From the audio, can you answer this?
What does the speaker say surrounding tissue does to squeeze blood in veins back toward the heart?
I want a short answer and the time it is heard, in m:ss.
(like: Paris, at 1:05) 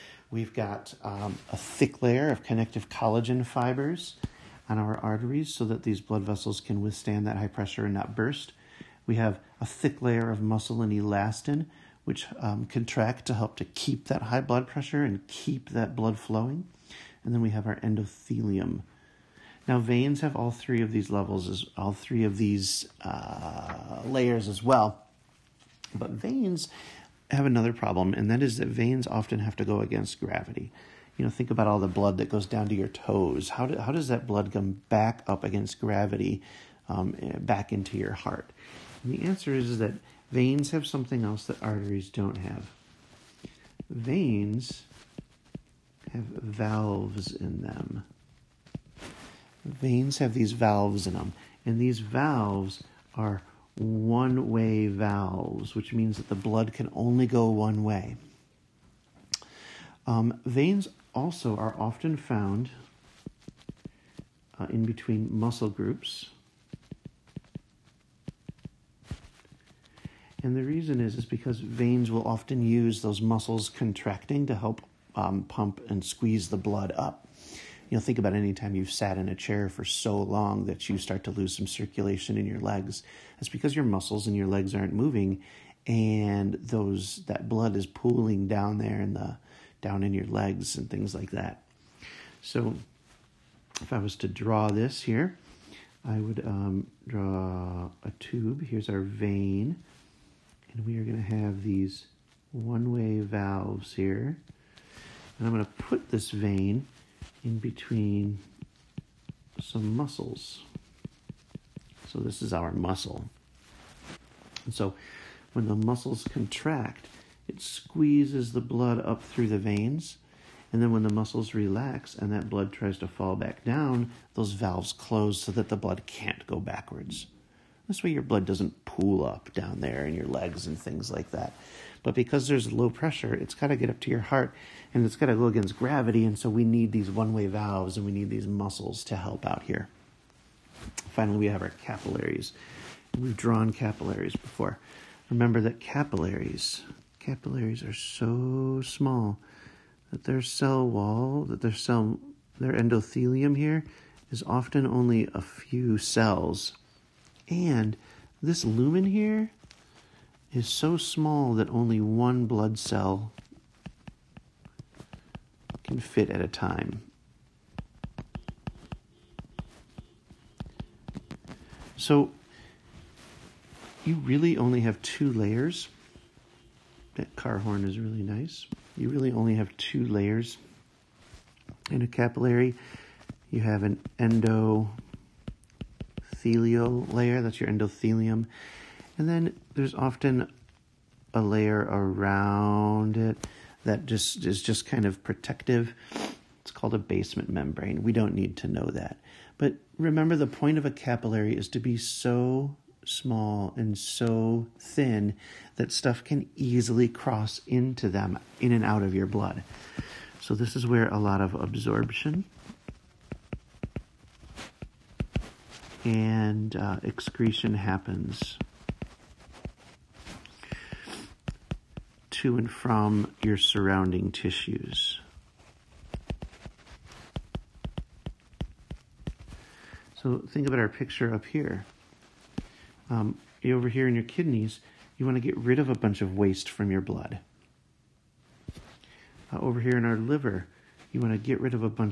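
Muscles contracting, at 1:13.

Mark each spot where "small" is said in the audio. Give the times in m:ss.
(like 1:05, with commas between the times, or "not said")
2:28, 2:40, 3:23.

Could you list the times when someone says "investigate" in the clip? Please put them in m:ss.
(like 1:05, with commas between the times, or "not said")
not said.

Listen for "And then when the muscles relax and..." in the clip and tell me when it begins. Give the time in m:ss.
2:00.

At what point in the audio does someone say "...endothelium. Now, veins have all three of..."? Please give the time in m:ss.
0:17.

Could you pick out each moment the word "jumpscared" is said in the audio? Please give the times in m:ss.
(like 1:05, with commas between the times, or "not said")
not said.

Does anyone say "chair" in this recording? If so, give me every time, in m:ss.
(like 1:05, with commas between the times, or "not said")
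1:19.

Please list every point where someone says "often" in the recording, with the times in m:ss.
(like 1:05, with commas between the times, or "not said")
0:29, 1:01, 1:12, 2:34, 3:09.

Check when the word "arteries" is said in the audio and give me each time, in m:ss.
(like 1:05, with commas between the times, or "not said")
0:04, 0:41.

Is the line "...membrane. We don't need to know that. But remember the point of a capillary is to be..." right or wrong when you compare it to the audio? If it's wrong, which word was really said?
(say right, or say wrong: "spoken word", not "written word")
right.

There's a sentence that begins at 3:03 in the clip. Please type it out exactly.
You have an endothelial layer, that's your endothelium.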